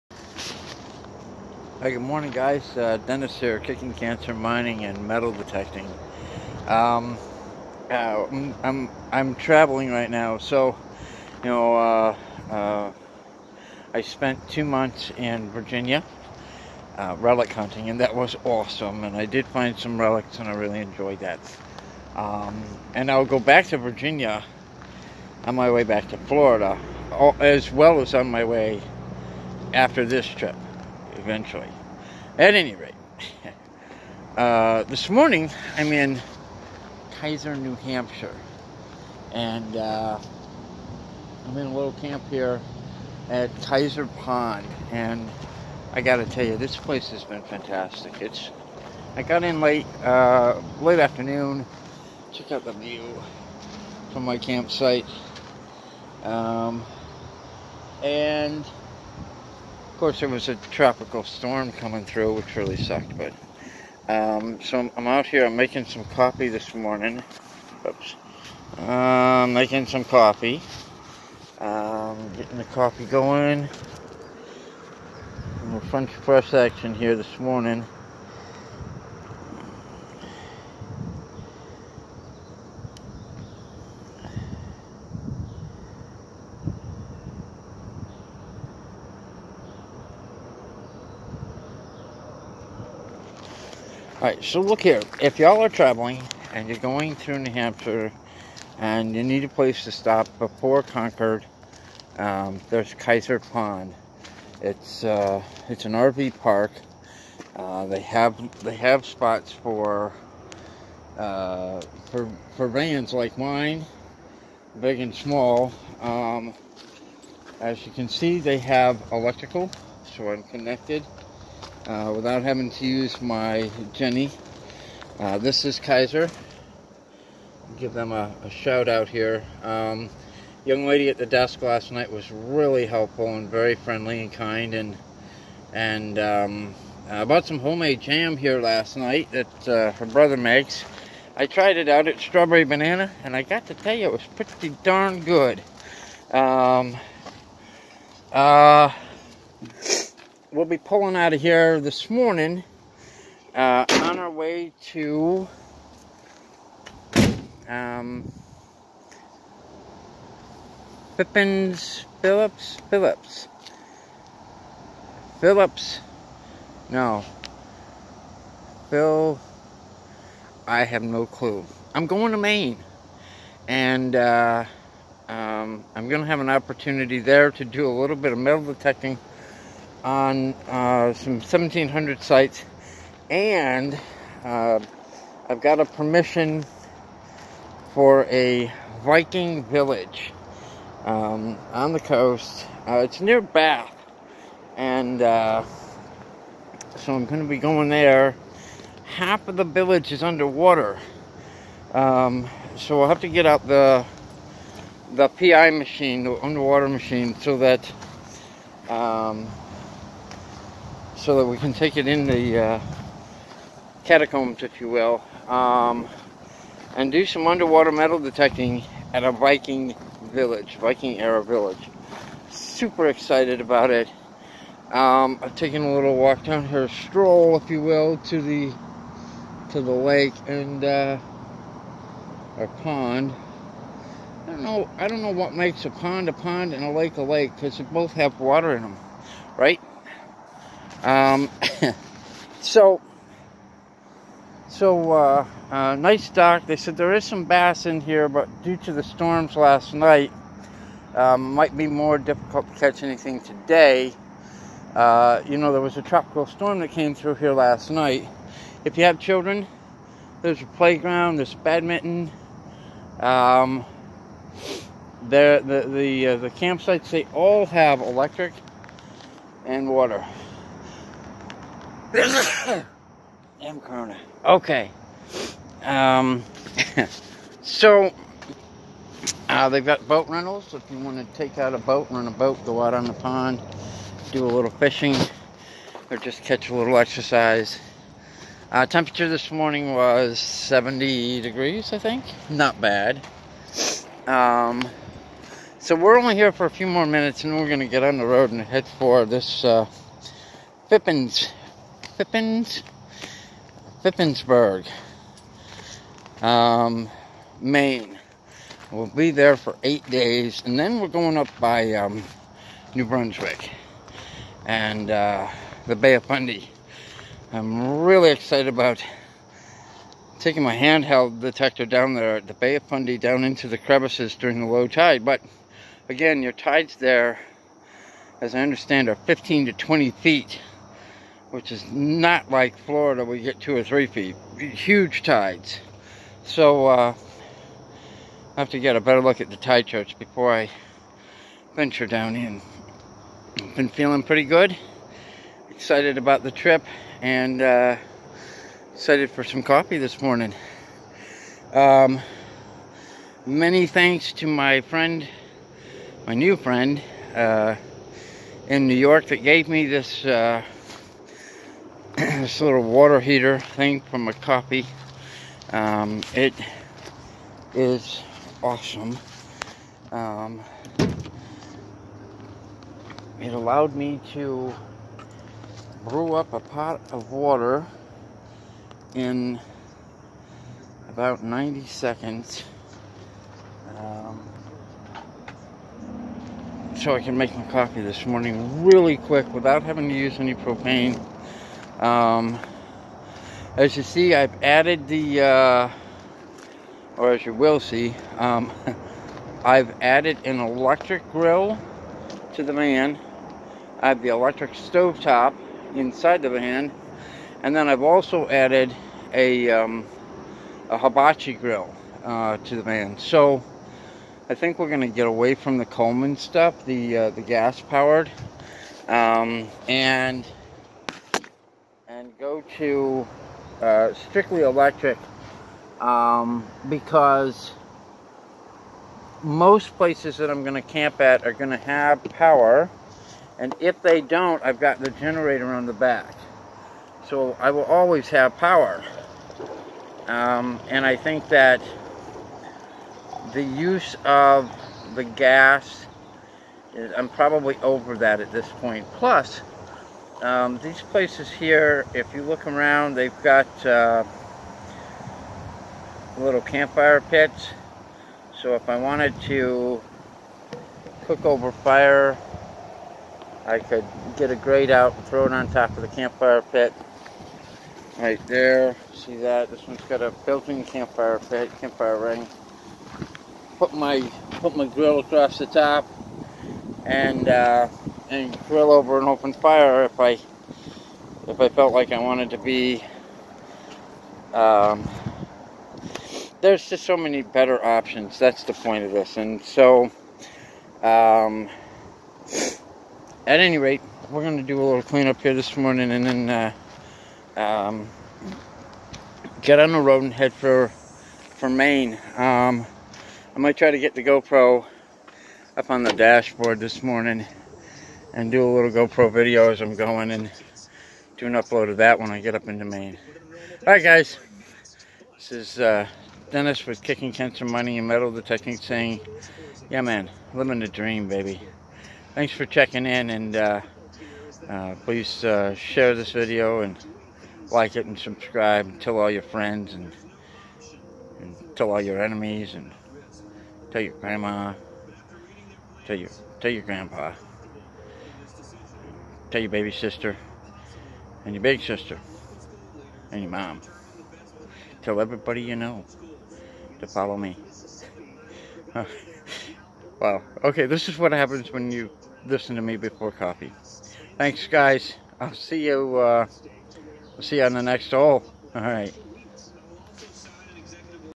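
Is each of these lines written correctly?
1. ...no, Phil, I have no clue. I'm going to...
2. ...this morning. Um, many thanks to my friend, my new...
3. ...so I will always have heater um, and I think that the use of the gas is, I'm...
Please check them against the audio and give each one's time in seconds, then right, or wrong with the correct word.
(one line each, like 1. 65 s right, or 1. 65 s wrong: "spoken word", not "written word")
1. 166 s right
2. 349 s right
3. 437 s wrong: "power", not "heater".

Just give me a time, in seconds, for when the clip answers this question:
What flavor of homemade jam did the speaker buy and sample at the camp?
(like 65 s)
142 s.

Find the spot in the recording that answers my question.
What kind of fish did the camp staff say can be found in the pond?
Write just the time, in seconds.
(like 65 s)
247 s.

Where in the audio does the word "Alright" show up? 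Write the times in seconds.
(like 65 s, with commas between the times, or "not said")
94 s, 513 s.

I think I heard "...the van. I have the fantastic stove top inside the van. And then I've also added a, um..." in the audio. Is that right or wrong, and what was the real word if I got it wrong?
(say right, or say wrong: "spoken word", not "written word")
wrong: "electric", not "fantastic".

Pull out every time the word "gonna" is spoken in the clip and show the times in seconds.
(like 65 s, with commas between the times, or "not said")
494 s.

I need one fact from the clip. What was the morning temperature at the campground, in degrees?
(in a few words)
70.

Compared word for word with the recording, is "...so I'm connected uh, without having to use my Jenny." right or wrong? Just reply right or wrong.
right.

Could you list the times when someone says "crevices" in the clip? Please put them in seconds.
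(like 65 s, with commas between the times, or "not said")
323 s.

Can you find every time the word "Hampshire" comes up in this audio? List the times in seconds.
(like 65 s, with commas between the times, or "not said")
37 s, 97 s.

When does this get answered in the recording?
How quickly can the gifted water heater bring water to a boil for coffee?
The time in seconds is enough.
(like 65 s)
381 s.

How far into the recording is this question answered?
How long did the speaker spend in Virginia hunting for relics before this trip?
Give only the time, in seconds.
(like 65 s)
14 s.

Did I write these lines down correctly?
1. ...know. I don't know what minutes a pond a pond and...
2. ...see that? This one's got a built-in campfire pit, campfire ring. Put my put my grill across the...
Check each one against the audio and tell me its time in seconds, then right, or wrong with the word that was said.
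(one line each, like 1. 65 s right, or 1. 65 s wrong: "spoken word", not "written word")
1. 234 s wrong: "makes", not "minutes"
2. 469 s right.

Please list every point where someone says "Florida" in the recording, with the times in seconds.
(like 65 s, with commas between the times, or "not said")
26 s, 332 s.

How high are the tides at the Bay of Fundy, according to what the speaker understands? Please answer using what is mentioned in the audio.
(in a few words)
15 to 20 feet.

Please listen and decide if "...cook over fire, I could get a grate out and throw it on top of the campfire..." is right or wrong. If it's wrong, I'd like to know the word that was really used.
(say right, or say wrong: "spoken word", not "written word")
right.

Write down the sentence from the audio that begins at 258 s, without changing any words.
If you have children, there's a playground, there's badminton.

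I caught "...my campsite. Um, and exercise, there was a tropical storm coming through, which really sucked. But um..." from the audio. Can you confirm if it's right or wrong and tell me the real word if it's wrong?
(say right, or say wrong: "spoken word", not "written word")
wrong: "course", not "exercise".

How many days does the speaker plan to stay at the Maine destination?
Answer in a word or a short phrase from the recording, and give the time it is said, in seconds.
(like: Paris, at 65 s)
8, at 309 s.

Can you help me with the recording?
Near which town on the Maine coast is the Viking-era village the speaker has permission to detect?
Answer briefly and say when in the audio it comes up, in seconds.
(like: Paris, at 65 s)
Bath, at 193 s.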